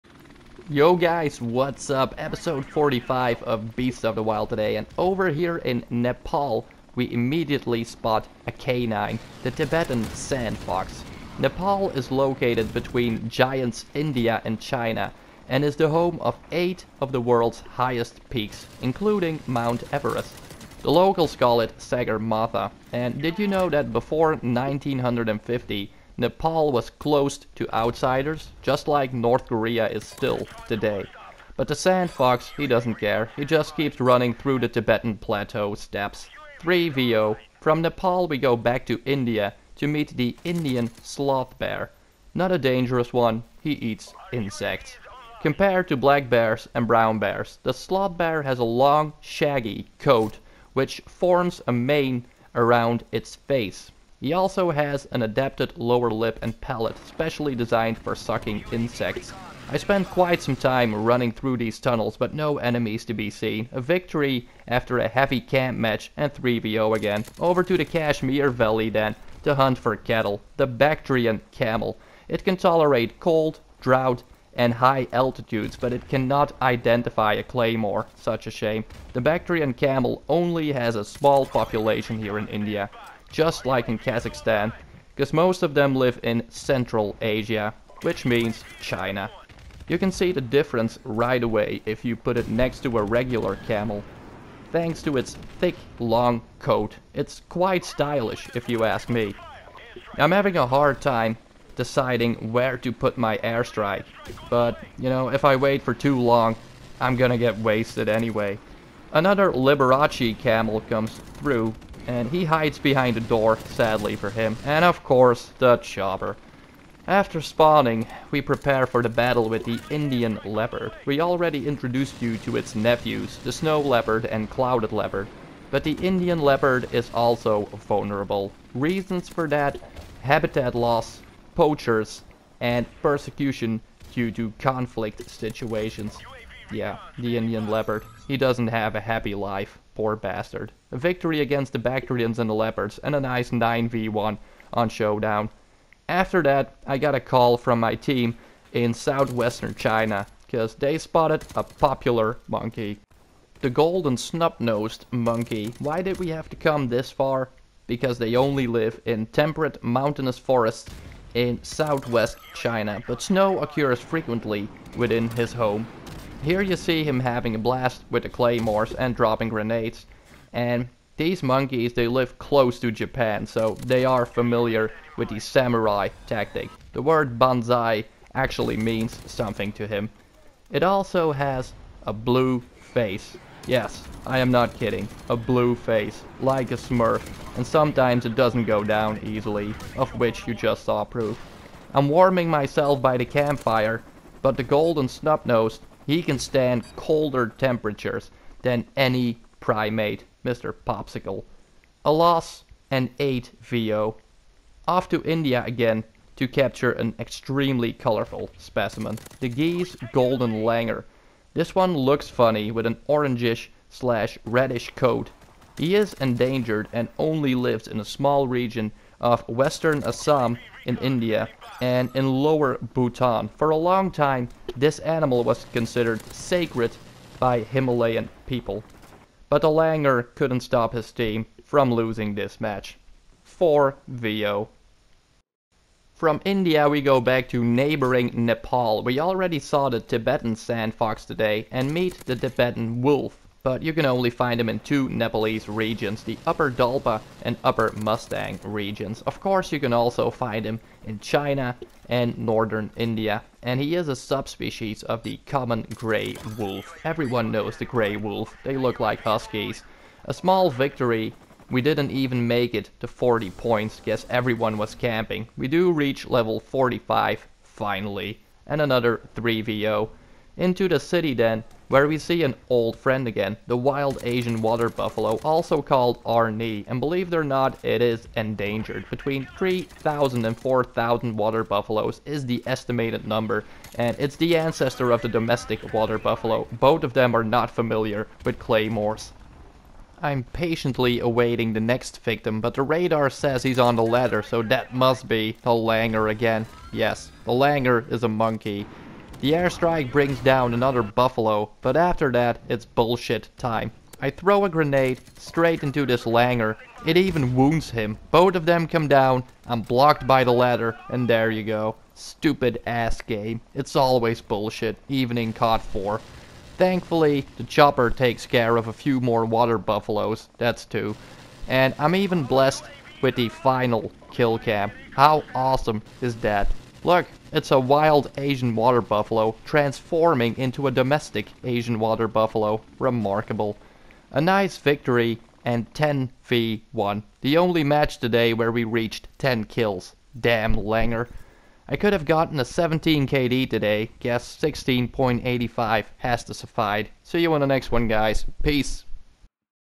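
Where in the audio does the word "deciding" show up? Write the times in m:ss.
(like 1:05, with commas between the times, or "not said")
1:41.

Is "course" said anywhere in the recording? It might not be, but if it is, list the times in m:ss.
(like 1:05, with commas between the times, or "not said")
1:55, 4:09.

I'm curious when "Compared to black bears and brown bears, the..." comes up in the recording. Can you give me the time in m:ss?
0:45.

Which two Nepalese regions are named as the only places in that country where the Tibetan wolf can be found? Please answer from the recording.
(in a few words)
Upper Dolpa and Upper Mustang.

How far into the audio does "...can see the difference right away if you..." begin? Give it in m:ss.
1:29.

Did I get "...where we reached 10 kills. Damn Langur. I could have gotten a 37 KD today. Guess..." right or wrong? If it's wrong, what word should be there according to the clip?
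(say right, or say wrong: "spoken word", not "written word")
wrong: "17", not "37".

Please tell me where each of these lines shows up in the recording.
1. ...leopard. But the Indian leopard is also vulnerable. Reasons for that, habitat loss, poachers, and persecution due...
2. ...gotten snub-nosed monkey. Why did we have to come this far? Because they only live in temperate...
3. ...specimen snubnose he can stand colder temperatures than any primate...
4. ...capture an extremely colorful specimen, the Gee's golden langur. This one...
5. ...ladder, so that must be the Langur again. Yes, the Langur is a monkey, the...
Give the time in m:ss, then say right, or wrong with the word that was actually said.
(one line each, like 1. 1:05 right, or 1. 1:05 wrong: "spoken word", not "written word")
1. 2:04 right
2. 2:33 wrong: "golden", not "gotten"
3. 3:14 wrong: "golden", not "specimen"
4. 3:26 right
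5. 4:54 right.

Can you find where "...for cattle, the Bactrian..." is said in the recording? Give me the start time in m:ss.
1:09.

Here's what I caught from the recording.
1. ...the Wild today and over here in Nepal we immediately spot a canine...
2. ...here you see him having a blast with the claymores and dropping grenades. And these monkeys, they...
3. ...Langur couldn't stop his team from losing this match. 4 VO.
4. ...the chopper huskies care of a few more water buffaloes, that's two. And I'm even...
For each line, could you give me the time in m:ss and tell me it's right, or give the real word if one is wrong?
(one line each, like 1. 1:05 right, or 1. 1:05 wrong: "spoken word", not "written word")
1. 0:04 right
2. 2:46 right
3. 3:49 right
4. 5:17 wrong: "takes", not "huskies".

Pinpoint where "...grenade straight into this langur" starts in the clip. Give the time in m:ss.
5:04.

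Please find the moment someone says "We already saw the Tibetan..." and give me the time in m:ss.
3:59.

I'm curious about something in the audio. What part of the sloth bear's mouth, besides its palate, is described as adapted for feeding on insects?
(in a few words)
lower lip.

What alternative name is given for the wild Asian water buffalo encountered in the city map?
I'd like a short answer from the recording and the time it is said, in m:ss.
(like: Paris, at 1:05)
Arni, at 4:36.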